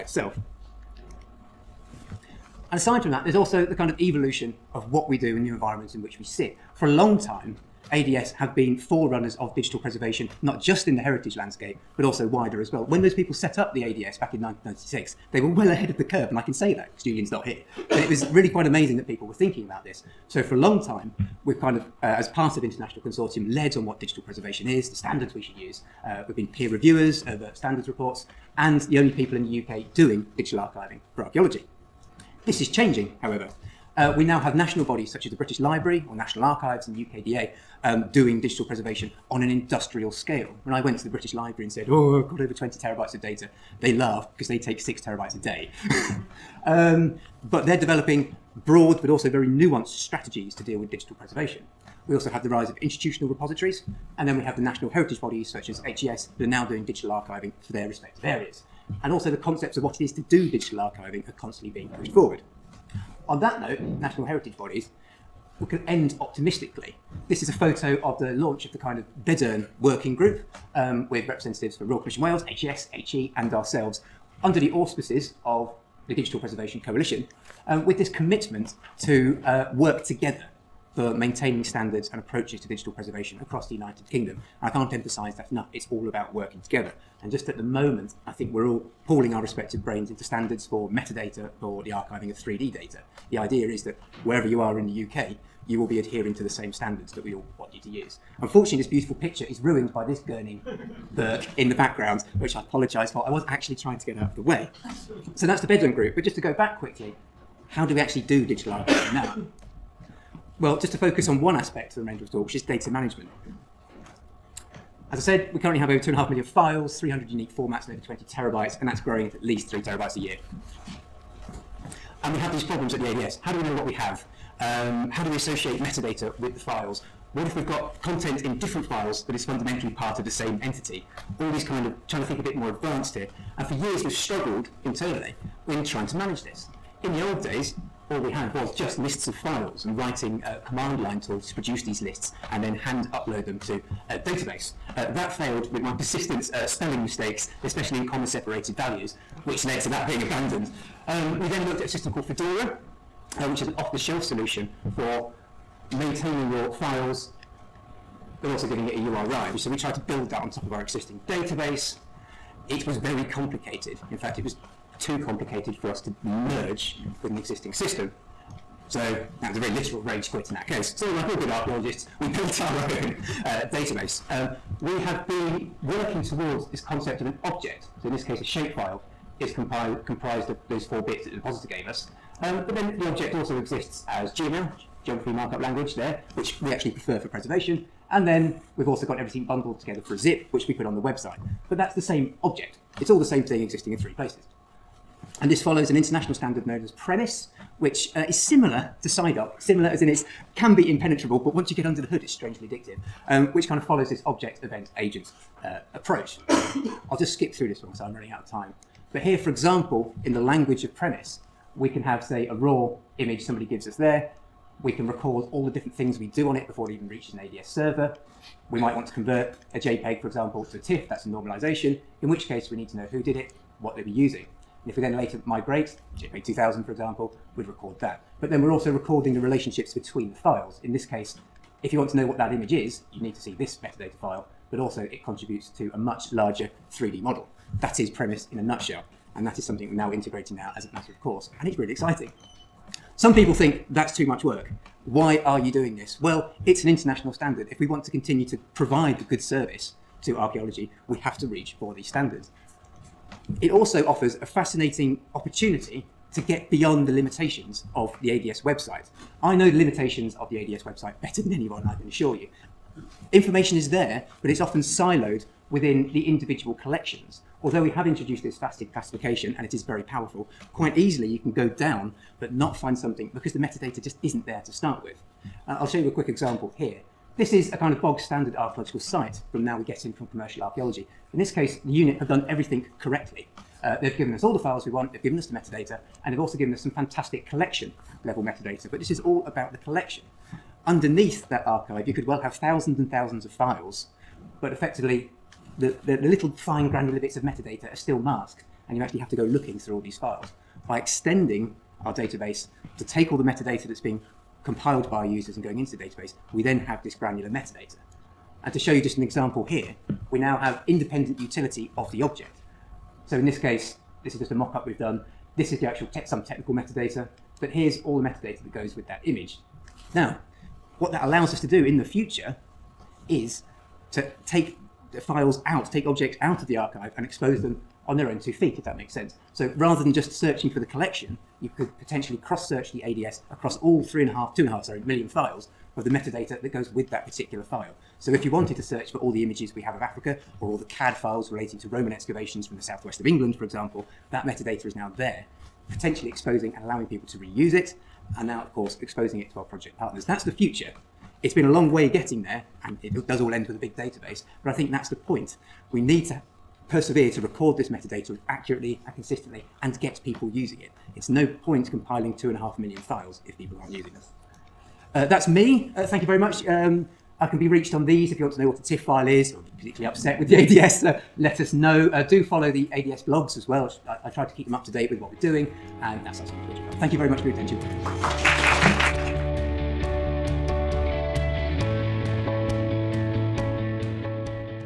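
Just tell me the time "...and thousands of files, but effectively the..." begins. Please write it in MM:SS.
04:52.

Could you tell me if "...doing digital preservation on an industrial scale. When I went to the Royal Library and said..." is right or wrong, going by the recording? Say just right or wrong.
wrong.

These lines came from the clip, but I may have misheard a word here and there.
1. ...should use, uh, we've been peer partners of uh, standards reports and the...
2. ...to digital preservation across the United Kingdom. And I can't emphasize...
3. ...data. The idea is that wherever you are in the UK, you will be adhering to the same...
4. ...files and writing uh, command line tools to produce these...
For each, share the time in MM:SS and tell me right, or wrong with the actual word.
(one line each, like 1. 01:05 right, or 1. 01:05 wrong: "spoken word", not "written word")
1. 00:25 wrong: "reviewers", not "partners"
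2. 01:22 right
3. 01:32 right
4. 02:19 right.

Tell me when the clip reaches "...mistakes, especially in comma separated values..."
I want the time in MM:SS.
02:27.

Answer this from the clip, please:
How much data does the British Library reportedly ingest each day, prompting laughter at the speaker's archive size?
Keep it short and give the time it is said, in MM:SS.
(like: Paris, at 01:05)
6 terabytes, at 00:44.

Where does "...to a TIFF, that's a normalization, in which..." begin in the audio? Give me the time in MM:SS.
03:40.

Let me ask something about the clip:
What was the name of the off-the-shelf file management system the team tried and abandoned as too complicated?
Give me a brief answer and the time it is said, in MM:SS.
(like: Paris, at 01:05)
Fedora, at 02:32.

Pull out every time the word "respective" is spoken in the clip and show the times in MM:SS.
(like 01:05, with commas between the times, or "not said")
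00:57, 01:29.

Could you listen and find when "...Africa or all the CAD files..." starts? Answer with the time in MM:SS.
05:40.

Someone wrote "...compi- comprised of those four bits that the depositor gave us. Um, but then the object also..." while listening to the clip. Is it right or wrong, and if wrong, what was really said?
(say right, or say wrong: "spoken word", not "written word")
right.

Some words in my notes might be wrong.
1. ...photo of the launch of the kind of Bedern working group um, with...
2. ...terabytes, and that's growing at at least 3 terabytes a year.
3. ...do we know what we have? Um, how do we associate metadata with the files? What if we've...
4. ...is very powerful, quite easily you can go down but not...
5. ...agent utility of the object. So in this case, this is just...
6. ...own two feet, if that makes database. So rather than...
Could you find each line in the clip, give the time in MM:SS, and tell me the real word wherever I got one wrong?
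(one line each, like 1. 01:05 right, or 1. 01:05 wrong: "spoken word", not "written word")
1. 01:07 right
2. 01:58 right
3. 02:03 right
4. 04:29 right
5. 05:10 wrong: "independent", not "agent"
6. 05:28 wrong: "sense", not "database".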